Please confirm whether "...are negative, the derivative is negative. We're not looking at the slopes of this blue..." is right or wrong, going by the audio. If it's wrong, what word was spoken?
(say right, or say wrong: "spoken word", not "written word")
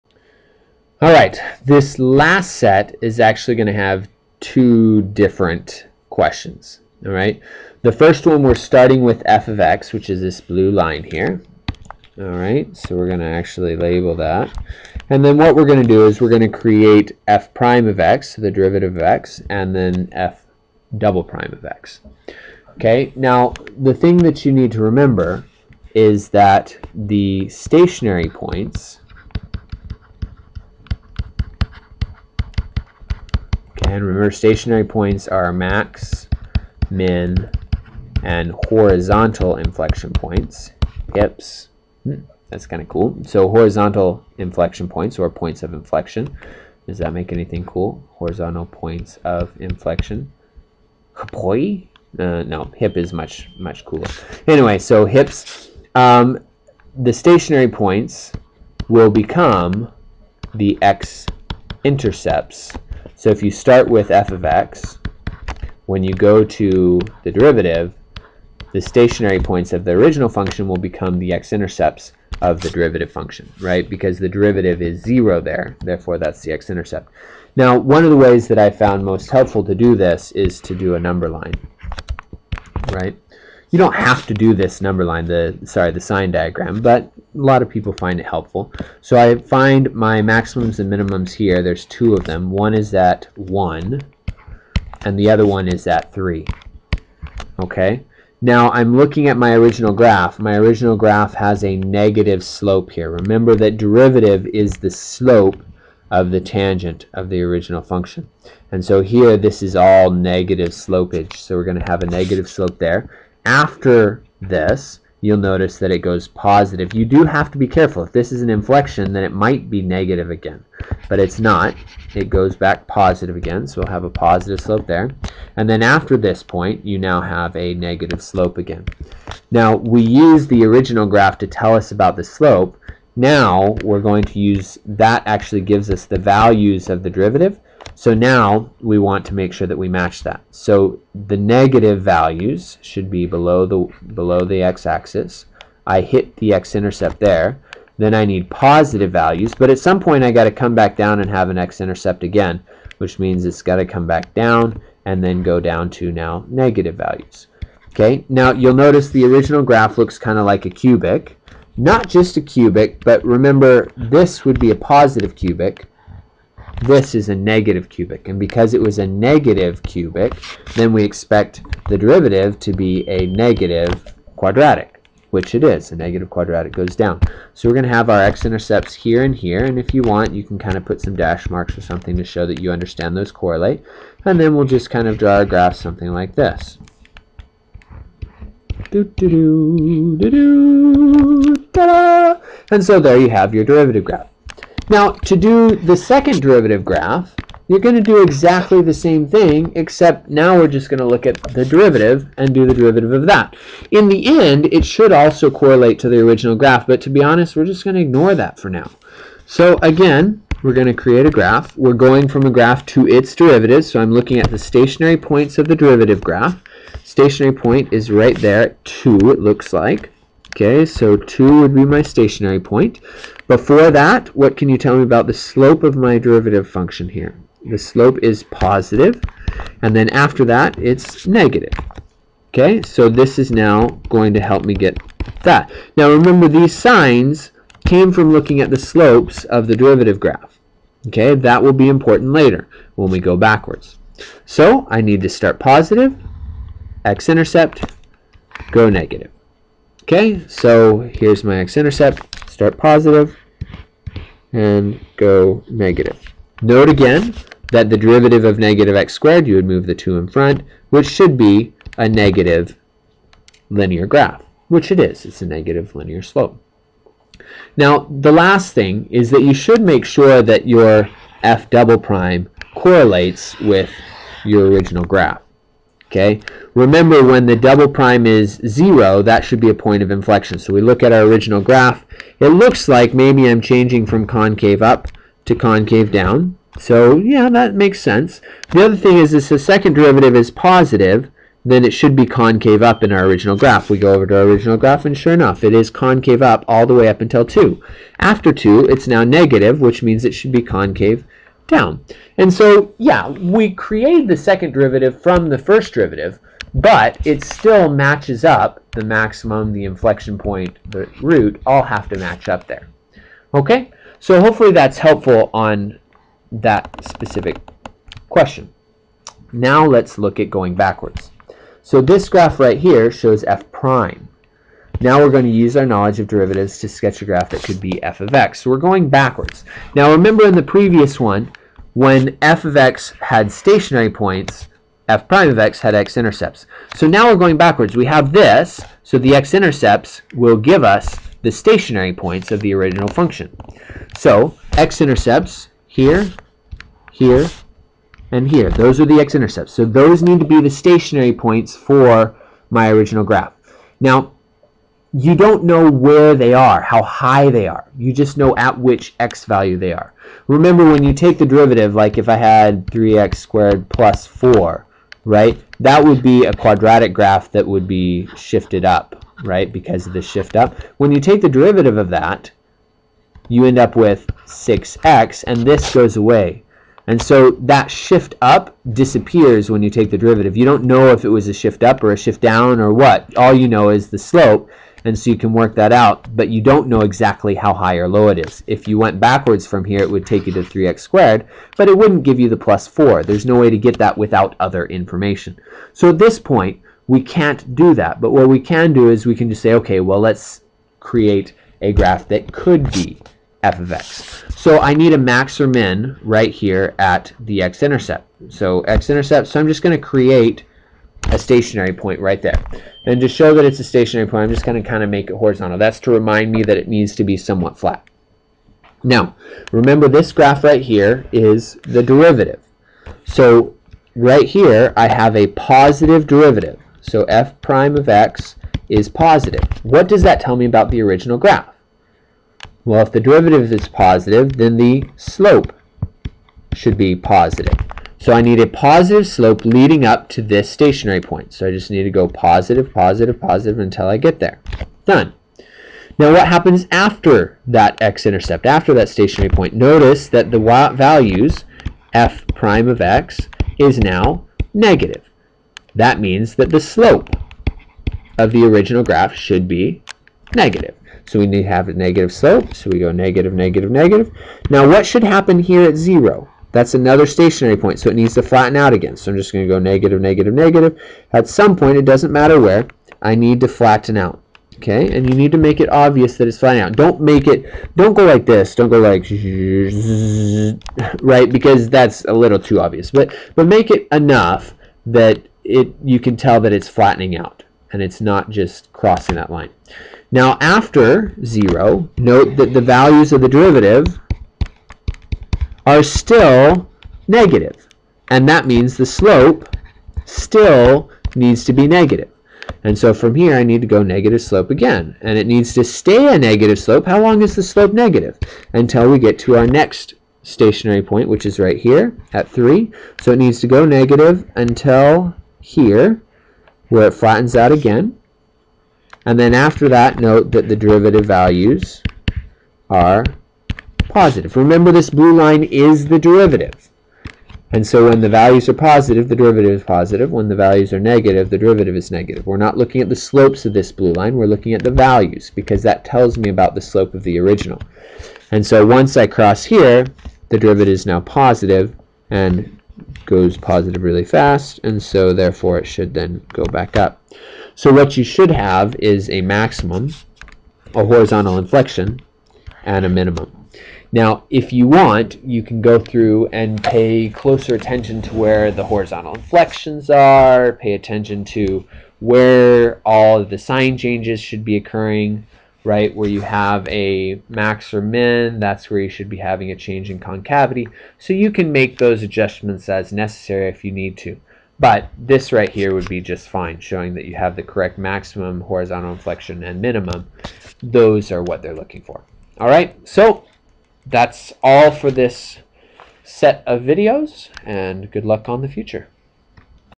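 right.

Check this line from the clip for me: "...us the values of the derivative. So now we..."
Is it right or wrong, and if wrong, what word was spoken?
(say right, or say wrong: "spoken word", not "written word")
right.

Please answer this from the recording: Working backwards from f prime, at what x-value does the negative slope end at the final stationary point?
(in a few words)
3.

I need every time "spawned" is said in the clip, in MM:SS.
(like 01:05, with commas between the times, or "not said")
not said.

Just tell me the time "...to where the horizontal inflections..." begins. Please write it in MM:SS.
09:18.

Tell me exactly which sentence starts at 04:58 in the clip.
After 2, it's now negative, which means it should be concave down.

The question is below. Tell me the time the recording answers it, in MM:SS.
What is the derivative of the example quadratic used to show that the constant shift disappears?
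06:14.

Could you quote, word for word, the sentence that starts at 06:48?
So x-intercept, so I'm just going to create a stationary point right there.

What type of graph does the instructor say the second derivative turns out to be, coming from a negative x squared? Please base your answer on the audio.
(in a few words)
negative linear graph.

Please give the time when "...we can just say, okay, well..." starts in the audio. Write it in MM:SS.
06:39.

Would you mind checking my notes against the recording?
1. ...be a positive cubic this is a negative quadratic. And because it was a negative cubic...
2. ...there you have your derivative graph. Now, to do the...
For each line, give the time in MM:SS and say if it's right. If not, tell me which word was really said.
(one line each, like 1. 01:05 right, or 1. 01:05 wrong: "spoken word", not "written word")
1. 02:44 wrong: "cubic", not "quadratic"
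2. 03:12 right.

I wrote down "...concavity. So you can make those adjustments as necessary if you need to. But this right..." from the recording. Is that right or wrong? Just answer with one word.
right.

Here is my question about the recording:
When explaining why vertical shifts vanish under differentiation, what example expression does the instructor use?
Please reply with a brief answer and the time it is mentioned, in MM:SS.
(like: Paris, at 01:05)
3x squared plus 4, at 06:02.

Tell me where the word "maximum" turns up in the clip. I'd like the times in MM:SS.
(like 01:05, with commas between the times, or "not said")
01:30, 05:09, 09:09, 09:37.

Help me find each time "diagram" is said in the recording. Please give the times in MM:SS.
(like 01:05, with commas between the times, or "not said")
01:26.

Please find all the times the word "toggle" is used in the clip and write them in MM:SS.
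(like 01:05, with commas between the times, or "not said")
not said.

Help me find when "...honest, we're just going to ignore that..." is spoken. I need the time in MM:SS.
03:27.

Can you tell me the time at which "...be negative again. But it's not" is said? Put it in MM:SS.
01:59.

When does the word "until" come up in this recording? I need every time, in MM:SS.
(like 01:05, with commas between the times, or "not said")
04:57, 07:23, 08:28, 08:34.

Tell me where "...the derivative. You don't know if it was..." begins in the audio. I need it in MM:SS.
06:20.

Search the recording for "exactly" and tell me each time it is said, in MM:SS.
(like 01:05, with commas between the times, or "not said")
03:18, 06:27.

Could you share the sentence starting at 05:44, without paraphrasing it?
So x-intercepts here, here, and here.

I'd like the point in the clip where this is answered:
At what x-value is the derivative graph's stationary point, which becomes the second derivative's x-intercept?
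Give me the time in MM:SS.
03:38.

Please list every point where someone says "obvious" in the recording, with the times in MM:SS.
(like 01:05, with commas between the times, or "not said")
07:55, 08:02.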